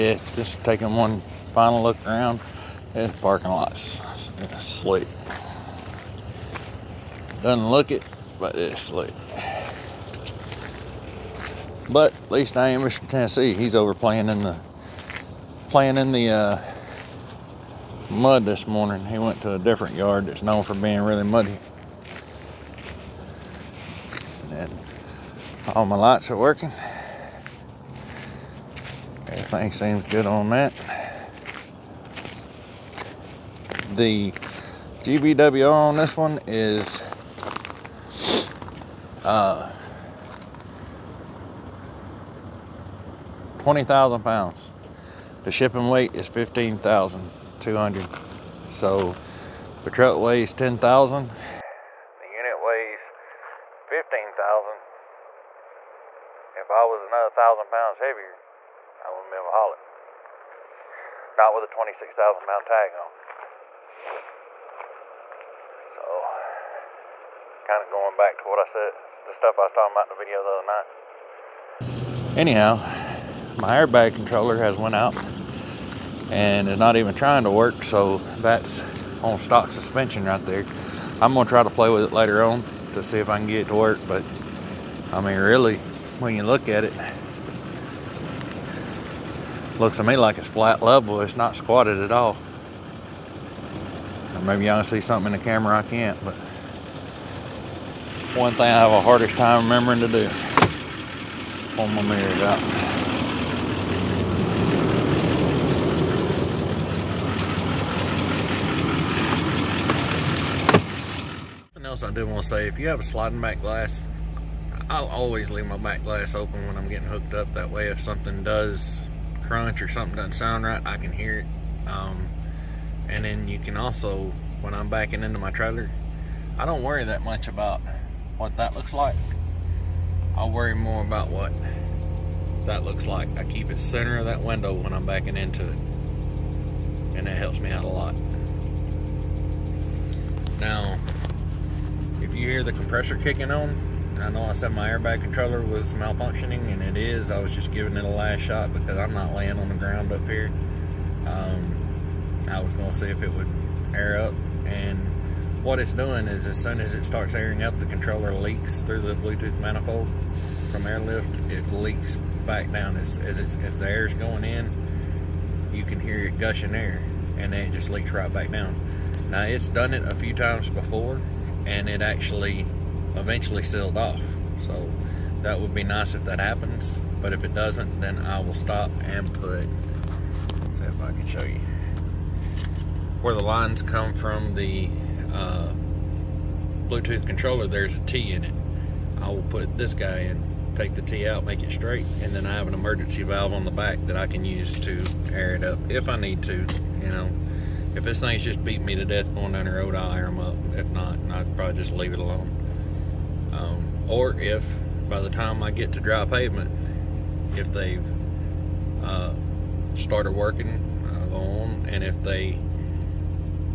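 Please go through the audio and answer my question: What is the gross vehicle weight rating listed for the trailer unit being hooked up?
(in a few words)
20,000 pounds.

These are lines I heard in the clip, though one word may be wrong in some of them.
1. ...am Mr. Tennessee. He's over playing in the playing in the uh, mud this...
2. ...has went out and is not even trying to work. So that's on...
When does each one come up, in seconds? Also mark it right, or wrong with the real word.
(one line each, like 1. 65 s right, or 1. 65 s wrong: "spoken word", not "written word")
1. 12 s right
2. 74 s right.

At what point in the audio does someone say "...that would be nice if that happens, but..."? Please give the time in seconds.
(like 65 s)
175 s.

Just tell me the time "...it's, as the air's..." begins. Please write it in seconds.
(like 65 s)
163 s.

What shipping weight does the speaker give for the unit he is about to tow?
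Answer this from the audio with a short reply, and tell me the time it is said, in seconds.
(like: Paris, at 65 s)
15,200, at 46 s.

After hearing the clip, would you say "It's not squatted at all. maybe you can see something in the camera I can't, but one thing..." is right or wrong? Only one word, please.
right.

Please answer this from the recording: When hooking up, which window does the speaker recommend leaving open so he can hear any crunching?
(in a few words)
sliding back glass.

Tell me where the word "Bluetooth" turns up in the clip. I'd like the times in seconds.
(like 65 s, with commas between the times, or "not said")
159 s, 186 s.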